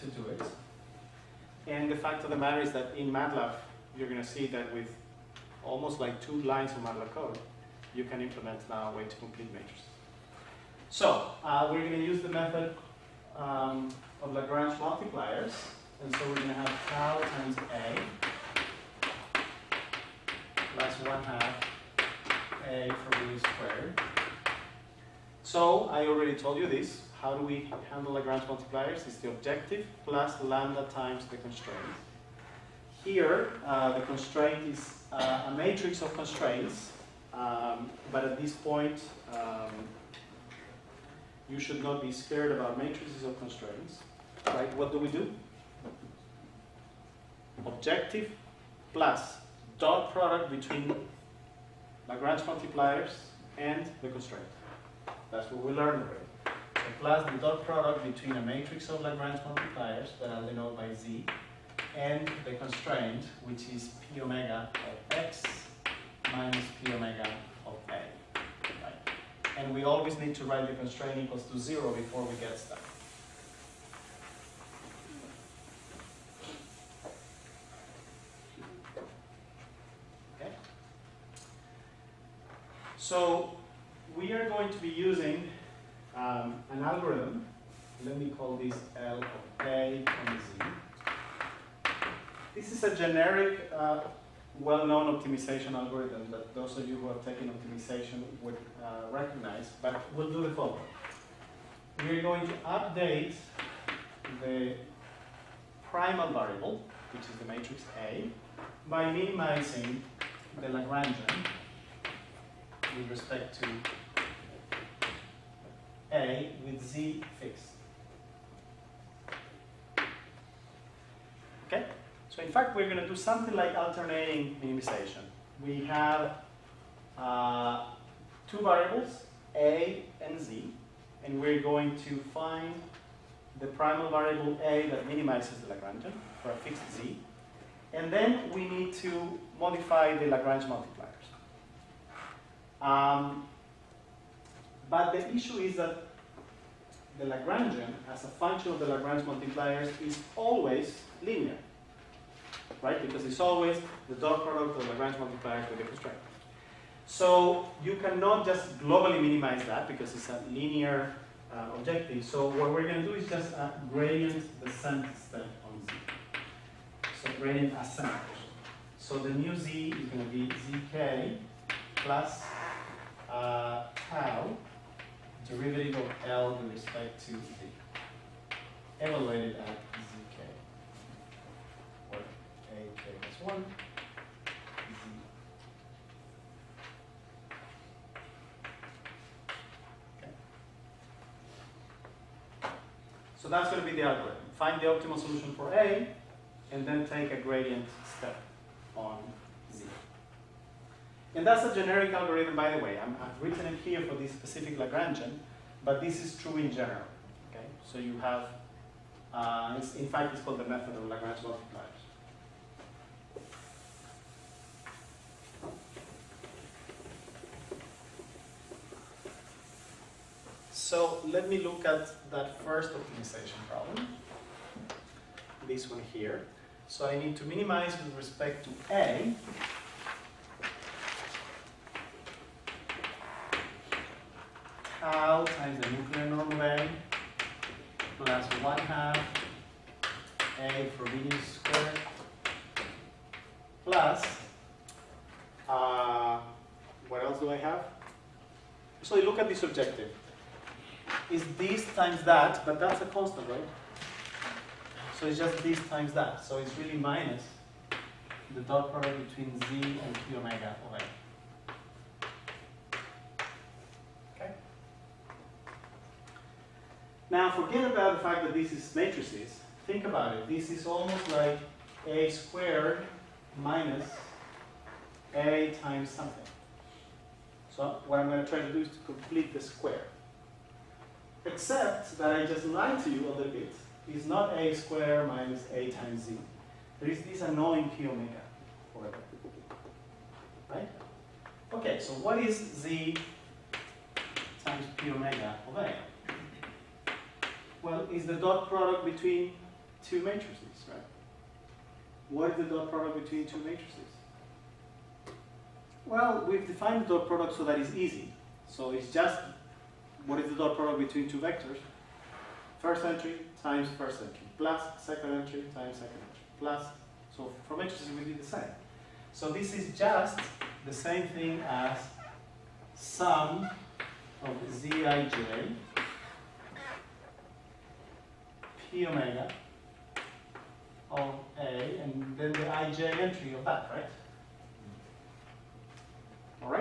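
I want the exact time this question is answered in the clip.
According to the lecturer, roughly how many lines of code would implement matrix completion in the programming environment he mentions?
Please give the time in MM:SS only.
00:06.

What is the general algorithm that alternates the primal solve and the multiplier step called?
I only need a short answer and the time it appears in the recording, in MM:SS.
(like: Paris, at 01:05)
method of Lagrange multipliers, at 03:30.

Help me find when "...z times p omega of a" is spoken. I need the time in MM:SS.
04:52.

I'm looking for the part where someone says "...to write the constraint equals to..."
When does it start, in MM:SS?
01:10.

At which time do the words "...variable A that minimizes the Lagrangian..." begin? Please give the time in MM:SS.
02:14.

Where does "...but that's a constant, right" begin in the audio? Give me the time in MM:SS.
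04:12.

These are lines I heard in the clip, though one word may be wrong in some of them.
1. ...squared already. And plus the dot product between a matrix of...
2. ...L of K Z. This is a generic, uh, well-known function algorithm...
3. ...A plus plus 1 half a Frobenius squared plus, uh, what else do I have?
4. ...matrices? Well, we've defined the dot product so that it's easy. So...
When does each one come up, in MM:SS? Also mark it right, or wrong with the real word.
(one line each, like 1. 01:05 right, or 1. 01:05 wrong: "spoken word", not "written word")
1. 00:55 wrong: "learned", not "squared"
2. 01:28 wrong: "optimization", not "function"
3. 03:56 right
4. 05:03 right.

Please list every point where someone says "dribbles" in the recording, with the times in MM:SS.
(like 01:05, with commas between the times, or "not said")
not said.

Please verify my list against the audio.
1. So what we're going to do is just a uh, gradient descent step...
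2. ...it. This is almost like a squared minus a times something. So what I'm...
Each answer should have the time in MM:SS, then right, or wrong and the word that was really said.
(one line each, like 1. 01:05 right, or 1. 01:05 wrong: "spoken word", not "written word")
1. 02:42 right
2. 04:30 right.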